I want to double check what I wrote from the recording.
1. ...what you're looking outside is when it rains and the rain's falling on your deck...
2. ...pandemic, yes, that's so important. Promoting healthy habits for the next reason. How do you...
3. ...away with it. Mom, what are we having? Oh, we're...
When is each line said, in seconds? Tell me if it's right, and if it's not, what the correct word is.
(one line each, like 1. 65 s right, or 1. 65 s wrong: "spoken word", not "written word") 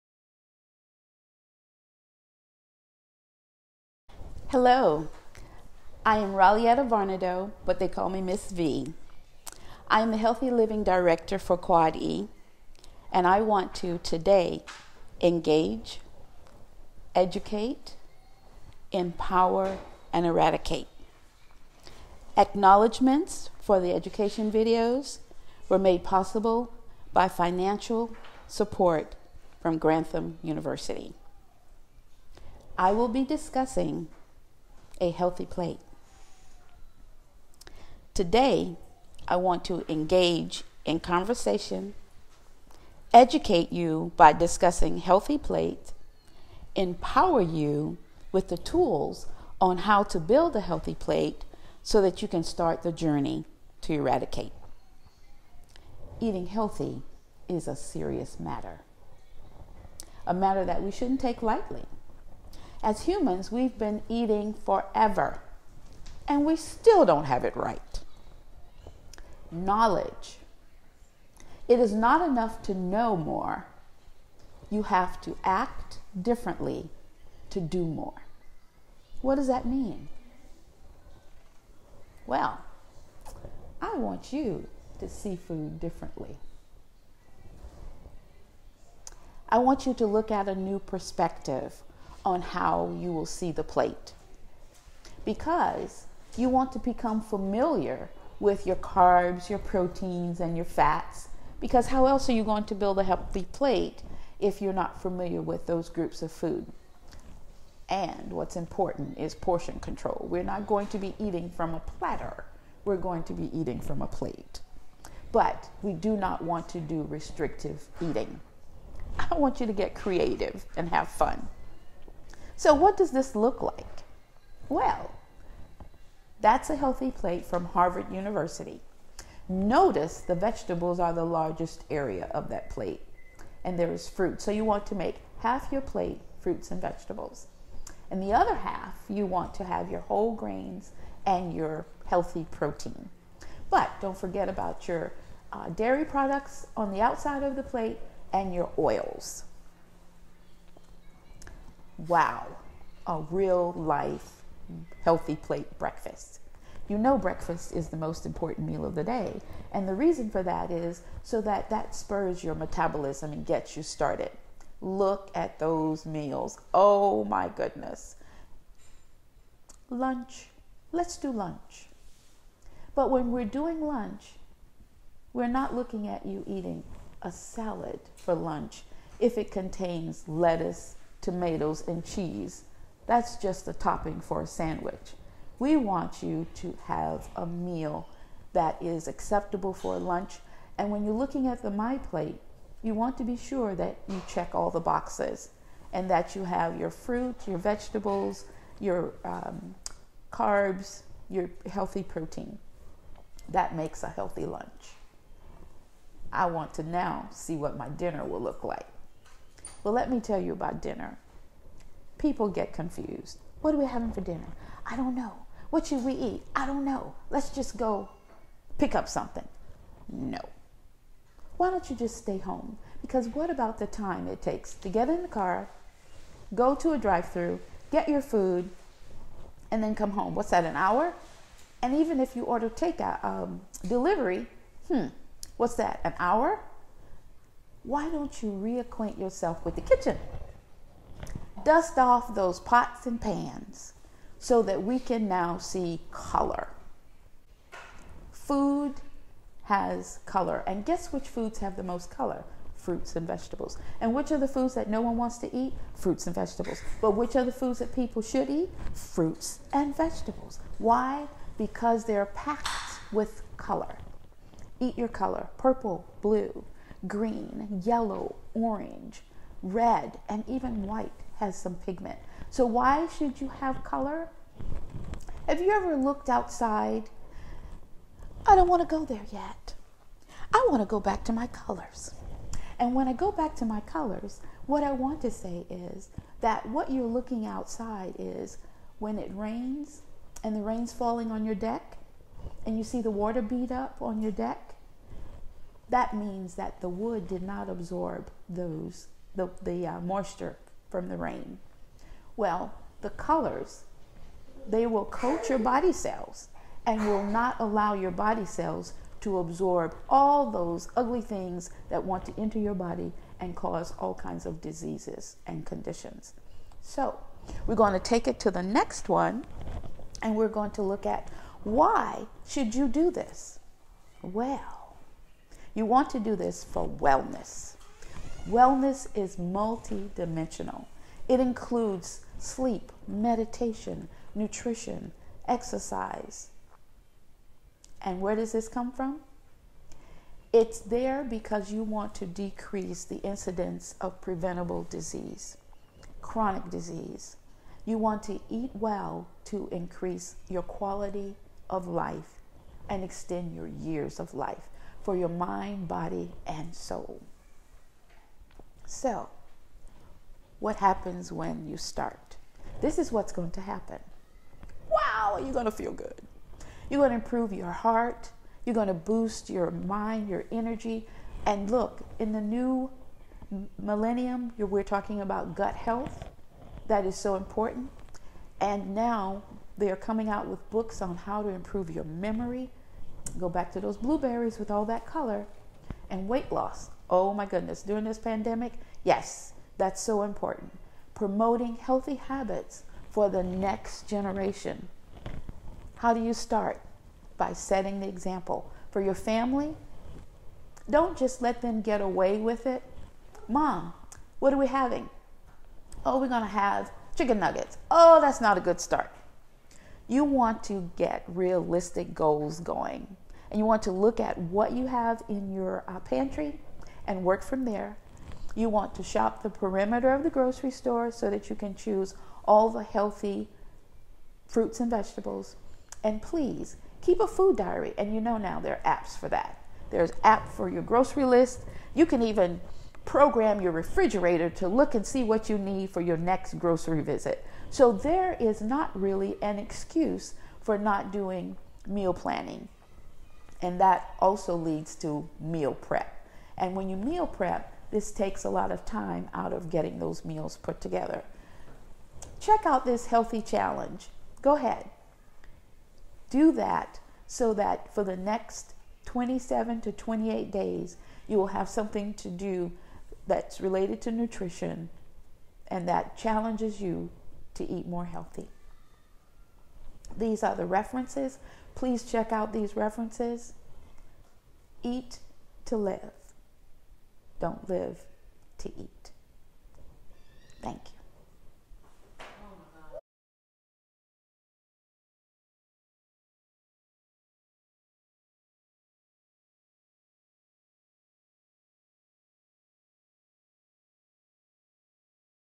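1. 286 s right
2. 388 s wrong: "generation", not "reason"
3. 402 s right.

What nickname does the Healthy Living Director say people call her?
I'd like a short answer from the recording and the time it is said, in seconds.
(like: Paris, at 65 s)
Miss V, at 8 s.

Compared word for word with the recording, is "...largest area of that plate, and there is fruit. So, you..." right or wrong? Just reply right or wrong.
right.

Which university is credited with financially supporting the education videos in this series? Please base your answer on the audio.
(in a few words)
Grantham University.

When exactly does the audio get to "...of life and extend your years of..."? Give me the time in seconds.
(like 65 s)
351 s.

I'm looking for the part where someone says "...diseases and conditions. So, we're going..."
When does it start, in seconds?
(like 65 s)
314 s.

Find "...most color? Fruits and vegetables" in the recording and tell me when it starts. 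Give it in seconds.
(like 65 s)
251 s.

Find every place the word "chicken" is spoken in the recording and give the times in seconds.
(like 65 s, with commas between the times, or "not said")
407 s.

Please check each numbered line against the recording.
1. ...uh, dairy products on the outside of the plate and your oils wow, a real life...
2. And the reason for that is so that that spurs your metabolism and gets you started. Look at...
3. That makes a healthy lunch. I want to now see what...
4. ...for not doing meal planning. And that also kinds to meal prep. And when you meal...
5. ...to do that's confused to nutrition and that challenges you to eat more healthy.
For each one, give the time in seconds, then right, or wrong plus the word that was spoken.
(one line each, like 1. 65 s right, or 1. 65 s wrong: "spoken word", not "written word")
1. 145 s right
2. 159 s right
3. 203 s right
4. 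440 s wrong: "leads", not "kinds"
5. 462 s wrong: "related", not "confused".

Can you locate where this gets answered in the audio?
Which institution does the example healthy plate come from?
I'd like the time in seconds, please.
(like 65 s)
127 s.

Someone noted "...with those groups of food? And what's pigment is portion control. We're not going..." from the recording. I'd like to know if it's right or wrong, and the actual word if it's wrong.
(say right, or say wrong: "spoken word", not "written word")
wrong: "important", not "pigment".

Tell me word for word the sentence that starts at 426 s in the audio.
And please keep a food diary.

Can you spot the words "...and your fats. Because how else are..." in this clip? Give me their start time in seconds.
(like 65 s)
100 s.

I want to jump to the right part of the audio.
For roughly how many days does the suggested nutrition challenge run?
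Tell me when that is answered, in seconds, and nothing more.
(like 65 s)
459 s.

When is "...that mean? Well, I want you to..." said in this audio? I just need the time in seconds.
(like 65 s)
79 s.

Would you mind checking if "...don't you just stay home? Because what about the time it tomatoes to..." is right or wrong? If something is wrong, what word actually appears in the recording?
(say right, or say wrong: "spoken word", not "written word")
wrong: "takes", not "tomatoes".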